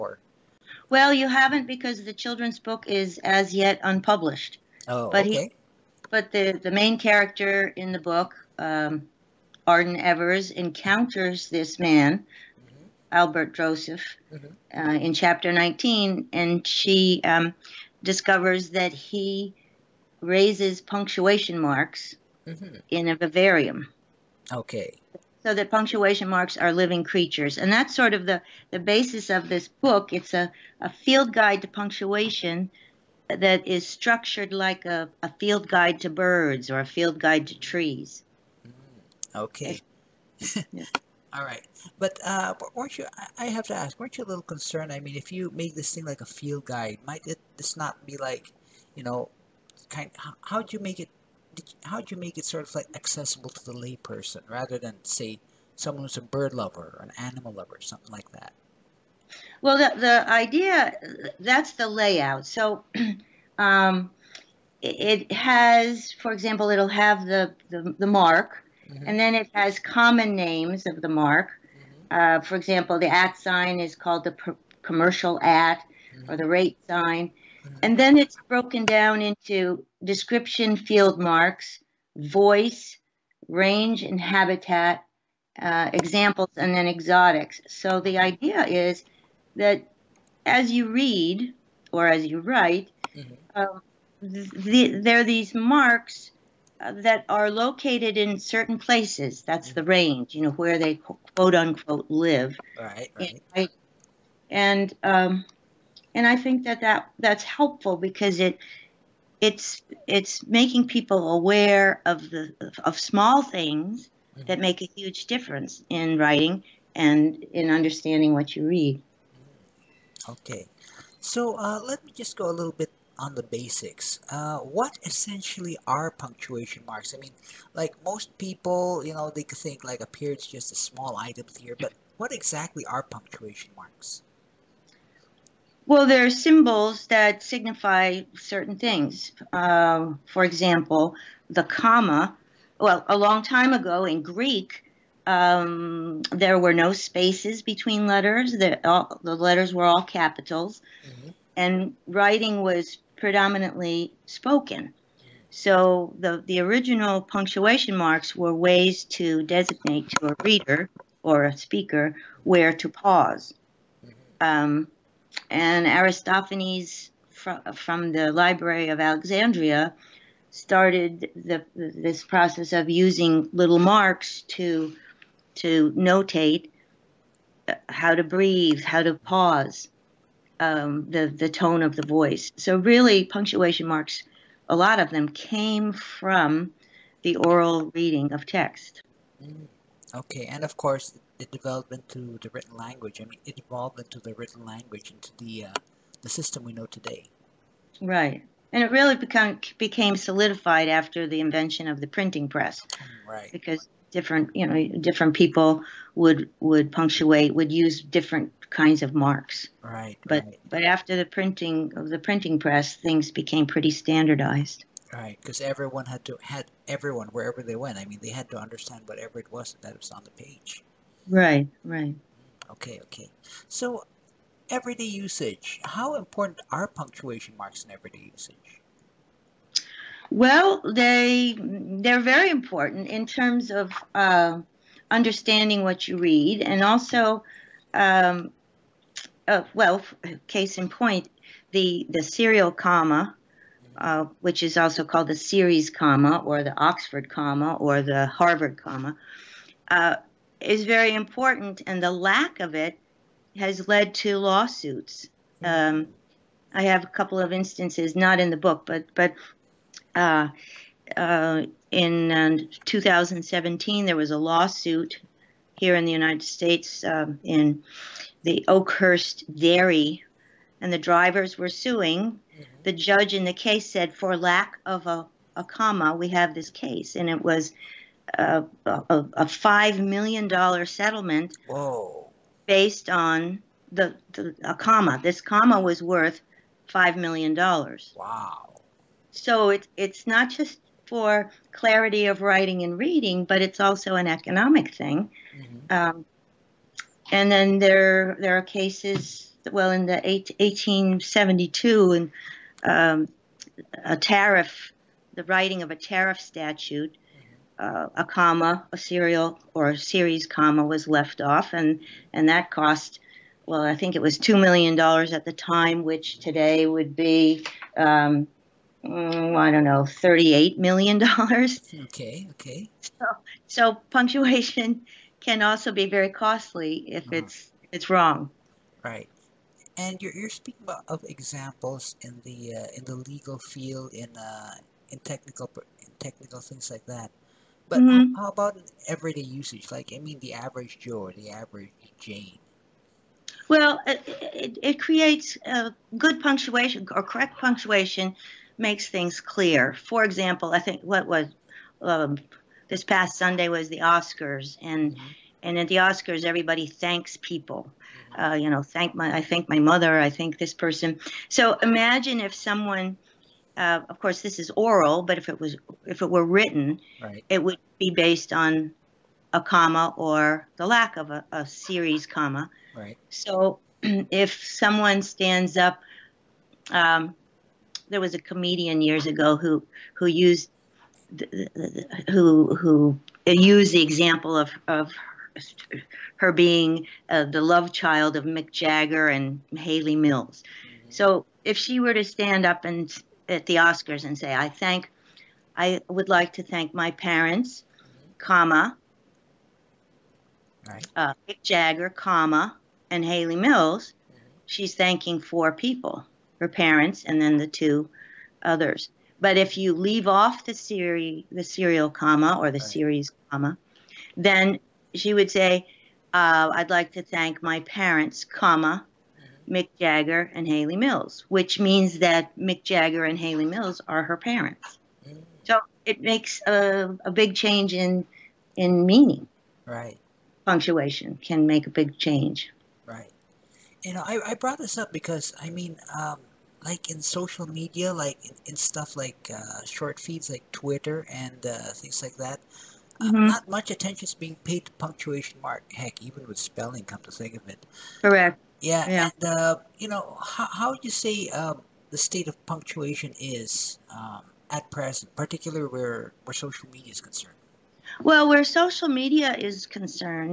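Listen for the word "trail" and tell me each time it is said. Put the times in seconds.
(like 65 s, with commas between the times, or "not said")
not said.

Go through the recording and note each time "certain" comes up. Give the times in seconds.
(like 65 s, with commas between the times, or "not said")
98 s, 138 s.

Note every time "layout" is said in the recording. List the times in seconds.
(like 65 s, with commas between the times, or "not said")
61 s.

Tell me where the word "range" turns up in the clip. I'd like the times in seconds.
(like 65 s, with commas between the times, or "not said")
83 s, 99 s.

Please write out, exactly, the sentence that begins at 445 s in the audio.
Heck, even with spelling, come to think of it.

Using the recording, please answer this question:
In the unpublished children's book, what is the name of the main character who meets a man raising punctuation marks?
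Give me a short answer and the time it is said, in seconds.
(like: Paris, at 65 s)
Arden Evers, at 9 s.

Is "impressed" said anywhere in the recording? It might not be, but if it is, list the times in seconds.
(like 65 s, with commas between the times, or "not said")
not said.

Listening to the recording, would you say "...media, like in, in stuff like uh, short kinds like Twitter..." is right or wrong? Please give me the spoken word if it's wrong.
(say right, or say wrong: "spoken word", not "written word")
wrong: "feeds", not "kinds".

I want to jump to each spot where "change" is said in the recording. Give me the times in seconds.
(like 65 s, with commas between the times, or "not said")
427 s, 432 s.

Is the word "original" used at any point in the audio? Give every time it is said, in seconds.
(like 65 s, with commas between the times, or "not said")
156 s.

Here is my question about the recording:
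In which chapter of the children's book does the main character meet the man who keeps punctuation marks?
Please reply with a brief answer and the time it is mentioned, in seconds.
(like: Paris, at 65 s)
19, at 15 s.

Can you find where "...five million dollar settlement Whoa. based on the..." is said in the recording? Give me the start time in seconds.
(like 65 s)
279 s.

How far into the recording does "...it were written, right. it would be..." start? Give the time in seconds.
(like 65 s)
366 s.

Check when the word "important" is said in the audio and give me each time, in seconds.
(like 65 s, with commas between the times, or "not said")
226 s, 232 s, 251 s.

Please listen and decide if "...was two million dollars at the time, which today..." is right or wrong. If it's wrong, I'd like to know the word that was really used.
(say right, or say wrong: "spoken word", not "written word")
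right.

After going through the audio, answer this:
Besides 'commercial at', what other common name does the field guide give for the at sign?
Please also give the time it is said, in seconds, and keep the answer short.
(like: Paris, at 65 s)
rate sign, at 76 s.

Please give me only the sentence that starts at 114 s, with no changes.
that make a huge difference in writing and in understanding what you read.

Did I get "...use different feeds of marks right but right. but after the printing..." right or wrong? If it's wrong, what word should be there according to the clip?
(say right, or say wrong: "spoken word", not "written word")
wrong: "kinds", not "feeds".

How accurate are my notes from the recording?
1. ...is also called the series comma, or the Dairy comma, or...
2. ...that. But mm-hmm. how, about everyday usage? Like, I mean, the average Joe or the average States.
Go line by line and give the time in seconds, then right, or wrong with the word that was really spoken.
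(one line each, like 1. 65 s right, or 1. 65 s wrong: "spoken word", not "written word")
1. 244 s wrong: "Oxford", not "Dairy"
2. 337 s wrong: "Jane", not "States".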